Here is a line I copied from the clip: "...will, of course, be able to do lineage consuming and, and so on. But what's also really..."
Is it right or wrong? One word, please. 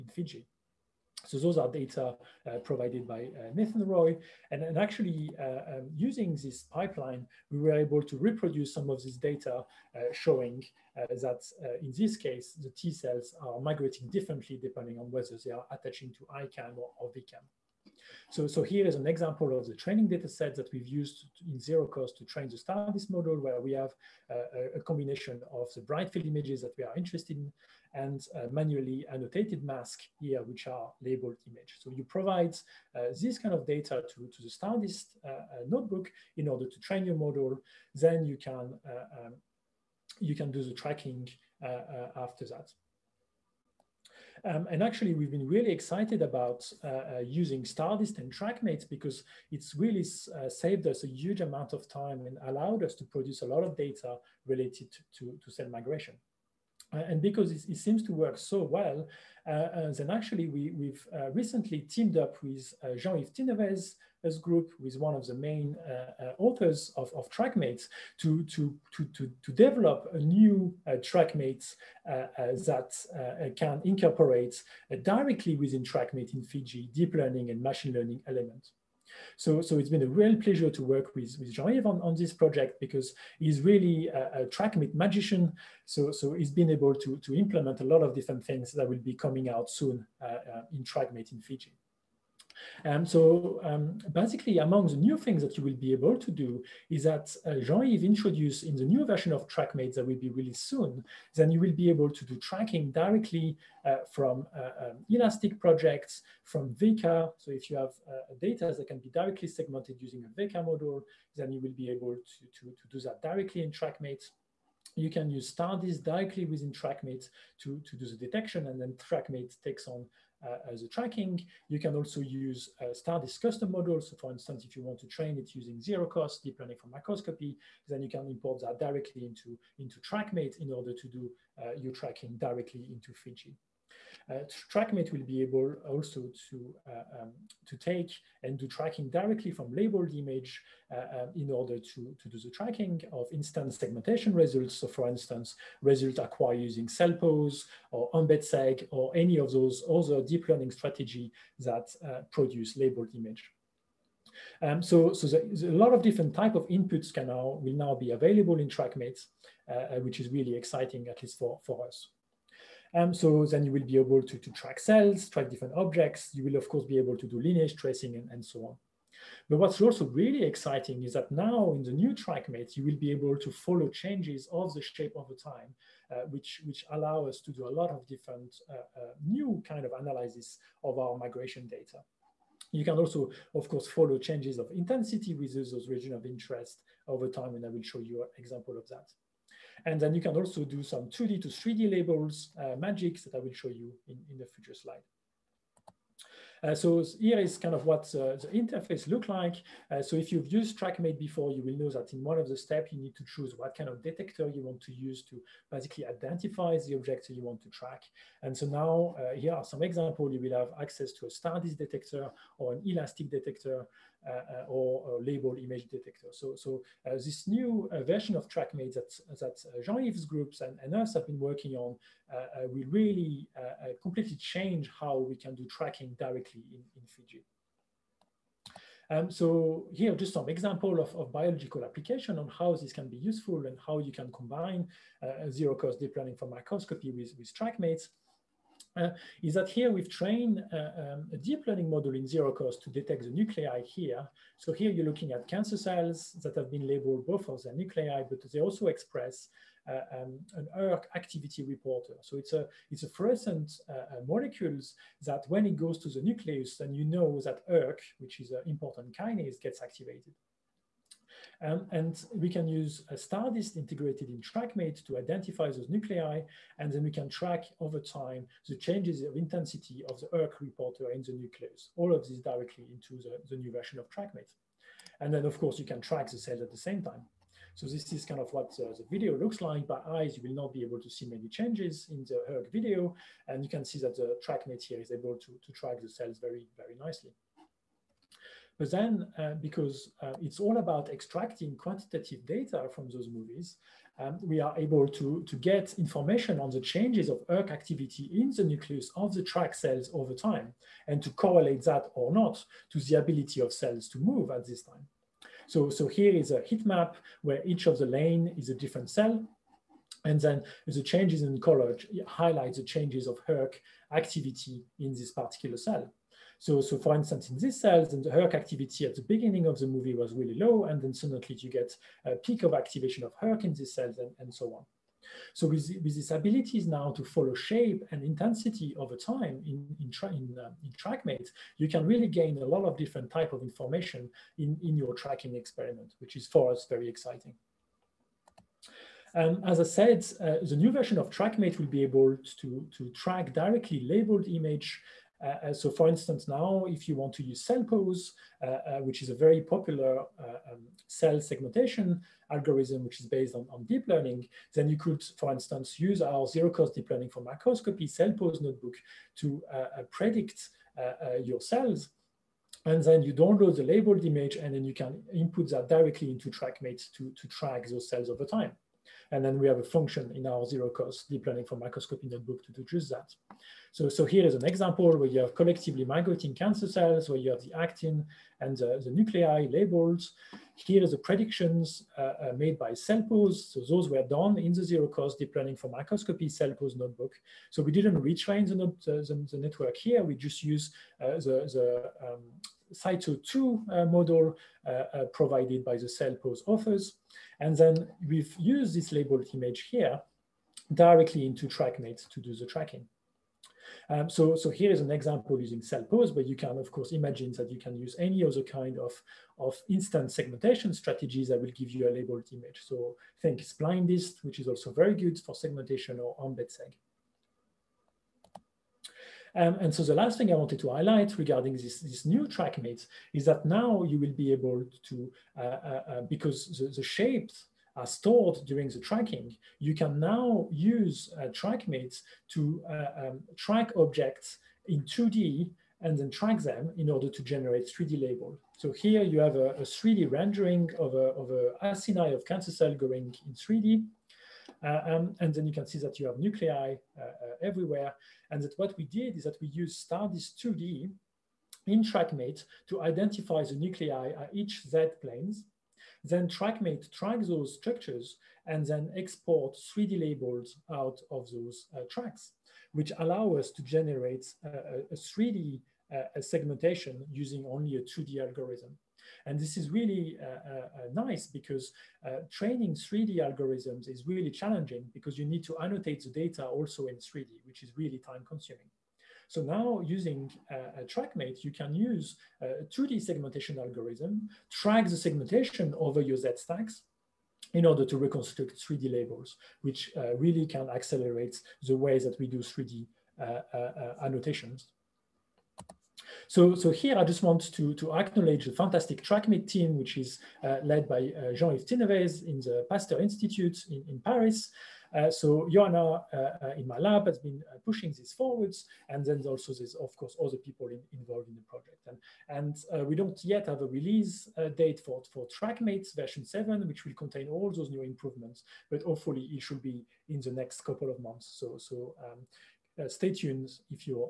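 wrong.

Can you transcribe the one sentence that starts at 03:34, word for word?
Uh, uh, or, or, label image detector.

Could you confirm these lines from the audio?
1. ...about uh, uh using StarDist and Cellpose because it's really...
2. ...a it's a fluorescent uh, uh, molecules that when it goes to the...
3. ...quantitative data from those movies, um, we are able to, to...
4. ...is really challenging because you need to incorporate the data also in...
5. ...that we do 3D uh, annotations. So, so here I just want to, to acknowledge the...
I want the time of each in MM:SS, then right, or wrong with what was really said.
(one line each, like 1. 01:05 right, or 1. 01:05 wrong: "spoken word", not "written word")
1. 00:46 wrong: "TrackMate", not "Cellpose"
2. 04:12 right
3. 04:51 right
4. 07:54 wrong: "annotate", not "incorporate"
5. 08:12 right.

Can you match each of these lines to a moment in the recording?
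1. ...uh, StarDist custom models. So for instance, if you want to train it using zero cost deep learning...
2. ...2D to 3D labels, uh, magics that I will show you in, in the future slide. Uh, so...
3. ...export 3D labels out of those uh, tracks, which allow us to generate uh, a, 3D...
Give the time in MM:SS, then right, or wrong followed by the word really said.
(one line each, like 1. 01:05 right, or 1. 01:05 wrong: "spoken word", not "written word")
1. 02:02 right
2. 03:11 right
3. 07:39 right.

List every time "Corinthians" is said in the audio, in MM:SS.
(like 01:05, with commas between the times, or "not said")
not said.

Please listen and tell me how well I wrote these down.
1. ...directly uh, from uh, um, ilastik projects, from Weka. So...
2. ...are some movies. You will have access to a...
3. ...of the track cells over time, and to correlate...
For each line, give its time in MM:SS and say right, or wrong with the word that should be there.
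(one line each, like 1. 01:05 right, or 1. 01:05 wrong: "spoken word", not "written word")
1. 01:42 right
2. 03:29 wrong: "examples", not "movies"
3. 04:59 right.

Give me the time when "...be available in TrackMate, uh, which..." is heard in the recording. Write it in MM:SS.
02:37.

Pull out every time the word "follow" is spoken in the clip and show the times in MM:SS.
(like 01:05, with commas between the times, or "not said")
02:53, 03:03, 05:27.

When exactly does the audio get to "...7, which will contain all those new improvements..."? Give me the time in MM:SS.
08:36.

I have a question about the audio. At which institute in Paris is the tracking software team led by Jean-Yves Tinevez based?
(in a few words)
Pasteur Institute.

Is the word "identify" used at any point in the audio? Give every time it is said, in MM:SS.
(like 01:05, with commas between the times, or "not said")
03:26, 04:25, 07:33.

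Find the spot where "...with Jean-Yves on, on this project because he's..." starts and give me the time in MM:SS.
01:21.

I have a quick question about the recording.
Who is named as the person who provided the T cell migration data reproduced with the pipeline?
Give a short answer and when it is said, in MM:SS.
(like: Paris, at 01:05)
Nathan Roy, at 00:03.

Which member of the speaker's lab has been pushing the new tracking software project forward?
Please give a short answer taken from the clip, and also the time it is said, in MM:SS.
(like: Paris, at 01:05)
Joanna, at 08:25.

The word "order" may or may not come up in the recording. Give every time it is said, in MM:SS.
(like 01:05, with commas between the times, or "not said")
00:36, 02:10, 02:21, 07:17, 08:07.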